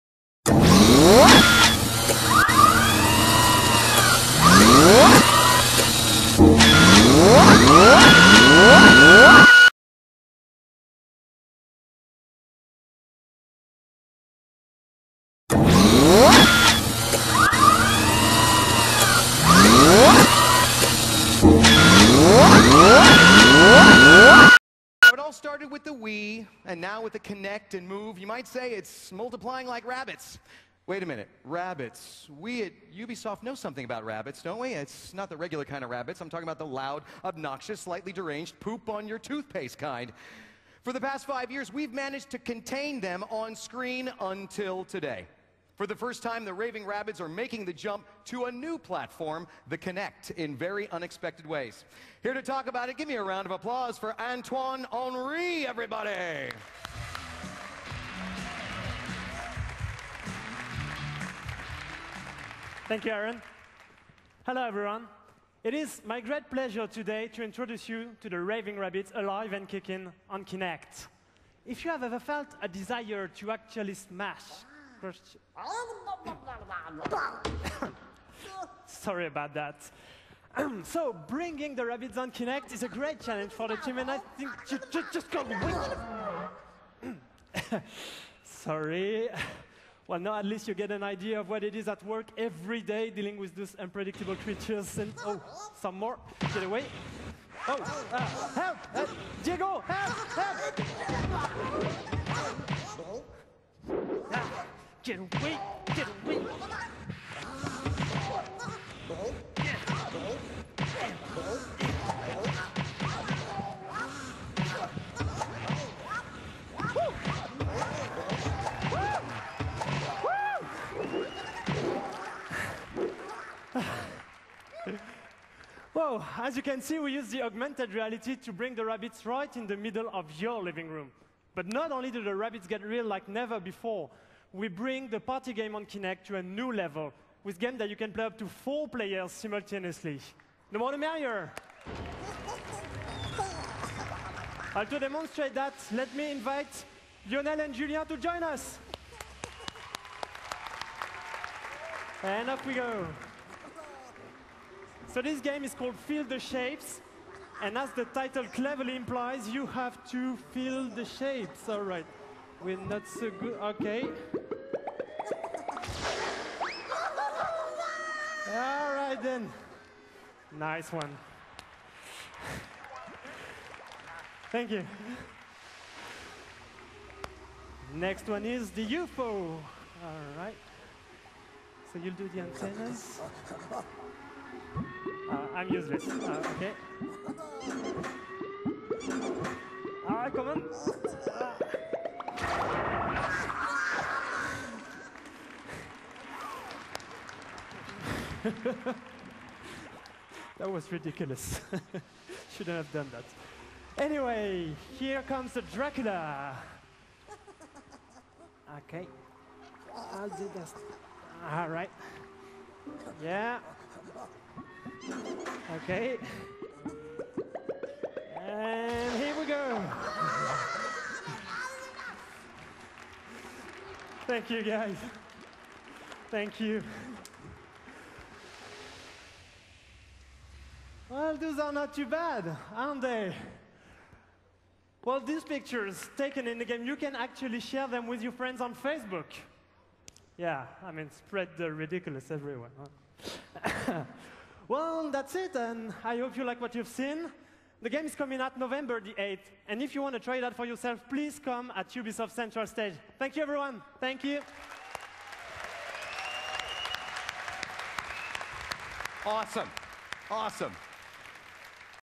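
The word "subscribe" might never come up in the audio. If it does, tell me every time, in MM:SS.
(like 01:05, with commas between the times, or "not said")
not said.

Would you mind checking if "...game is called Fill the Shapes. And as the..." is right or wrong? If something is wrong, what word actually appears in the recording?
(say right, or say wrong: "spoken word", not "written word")
right.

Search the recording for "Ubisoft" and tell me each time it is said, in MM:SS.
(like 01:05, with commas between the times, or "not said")
00:32, 04:11.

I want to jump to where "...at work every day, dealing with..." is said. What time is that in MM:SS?
01:31.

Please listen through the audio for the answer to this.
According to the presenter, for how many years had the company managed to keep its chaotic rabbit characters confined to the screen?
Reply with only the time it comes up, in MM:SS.
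00:41.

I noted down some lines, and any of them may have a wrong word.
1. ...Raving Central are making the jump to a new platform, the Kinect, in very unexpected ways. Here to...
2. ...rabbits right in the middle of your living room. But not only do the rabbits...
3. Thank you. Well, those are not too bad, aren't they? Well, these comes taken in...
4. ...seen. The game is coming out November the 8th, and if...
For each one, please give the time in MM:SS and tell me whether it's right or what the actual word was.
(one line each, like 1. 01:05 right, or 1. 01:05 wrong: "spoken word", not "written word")
1. 00:46 wrong: "Rabbids", not "Central"
2. 02:08 right
3. 03:46 wrong: "pictures", not "comes"
4. 04:06 right.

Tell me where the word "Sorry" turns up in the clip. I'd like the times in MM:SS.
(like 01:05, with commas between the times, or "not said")
01:18, 01:28.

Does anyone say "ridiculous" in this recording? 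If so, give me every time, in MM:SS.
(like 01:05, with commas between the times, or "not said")
03:20, 04:01.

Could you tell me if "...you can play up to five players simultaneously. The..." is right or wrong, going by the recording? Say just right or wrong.
wrong.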